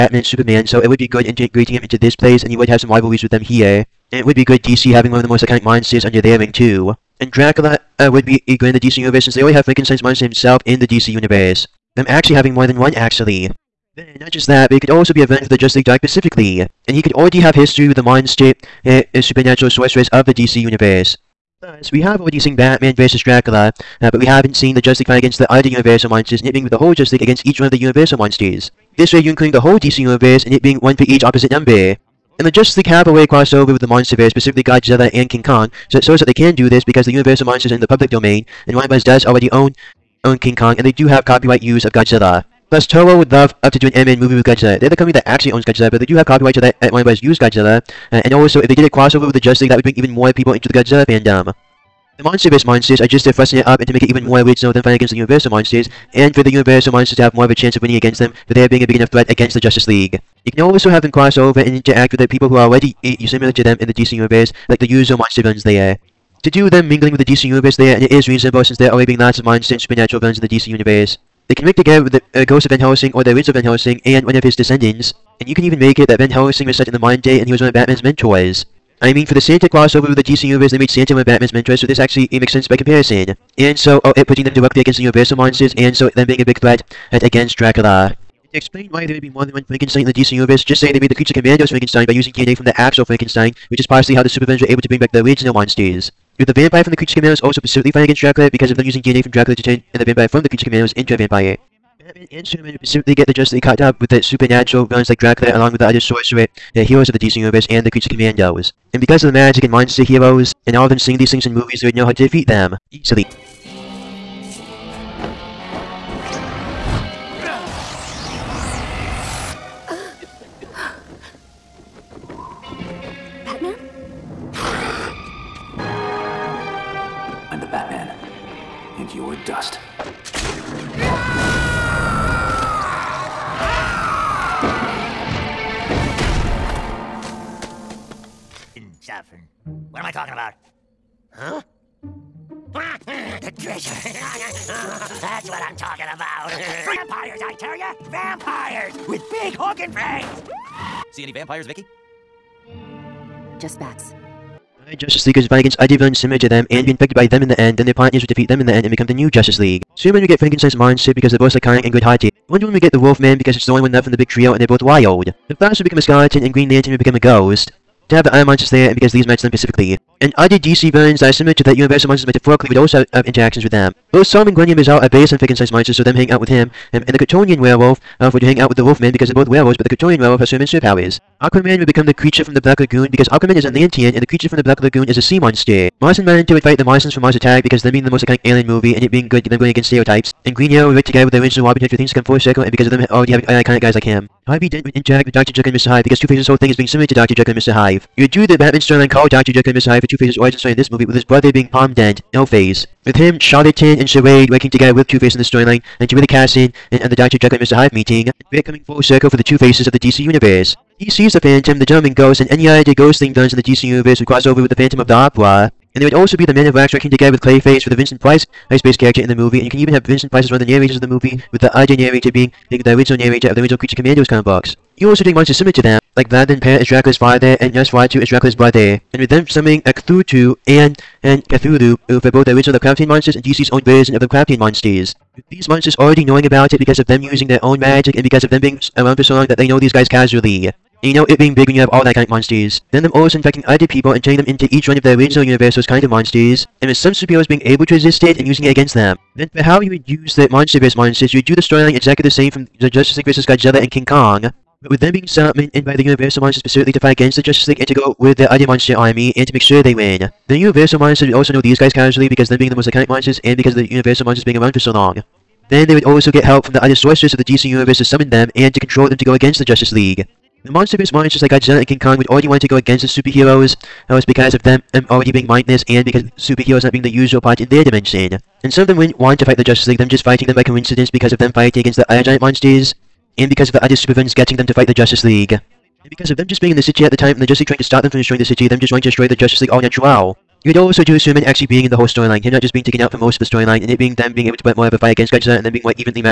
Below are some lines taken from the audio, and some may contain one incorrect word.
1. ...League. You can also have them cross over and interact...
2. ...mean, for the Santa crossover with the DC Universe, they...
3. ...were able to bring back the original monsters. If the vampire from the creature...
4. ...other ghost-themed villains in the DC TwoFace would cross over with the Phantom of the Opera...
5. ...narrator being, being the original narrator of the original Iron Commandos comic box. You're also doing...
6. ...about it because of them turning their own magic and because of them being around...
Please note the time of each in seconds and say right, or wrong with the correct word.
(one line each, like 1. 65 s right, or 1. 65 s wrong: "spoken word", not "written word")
1. 59 s right
2. 79 s right
3. 94 s right
4. 212 s wrong: "Universe", not "TwoFace"
5. 221 s wrong: "Creature", not "Iron"
6. 236 s wrong: "using", not "turning".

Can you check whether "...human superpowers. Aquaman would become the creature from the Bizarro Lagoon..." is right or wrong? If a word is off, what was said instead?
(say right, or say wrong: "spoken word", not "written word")
wrong: "Black", not "Bizarro".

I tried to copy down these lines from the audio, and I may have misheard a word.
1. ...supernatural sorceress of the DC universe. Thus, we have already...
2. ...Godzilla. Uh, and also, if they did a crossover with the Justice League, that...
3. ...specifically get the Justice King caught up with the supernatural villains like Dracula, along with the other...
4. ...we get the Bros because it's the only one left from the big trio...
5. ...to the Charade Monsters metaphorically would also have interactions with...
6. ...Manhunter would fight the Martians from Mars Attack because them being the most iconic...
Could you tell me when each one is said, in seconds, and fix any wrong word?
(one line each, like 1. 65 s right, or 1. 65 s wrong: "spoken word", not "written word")
1. 19 s right
2. 47 s right
3. 102 s wrong: "League", not "King"
4. 162 s wrong: "Wolfman", not "Bros"
5. 171 s wrong: "Universal", not "Charade"
6. 186 s right.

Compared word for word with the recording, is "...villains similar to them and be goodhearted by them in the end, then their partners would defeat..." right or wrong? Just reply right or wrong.
wrong.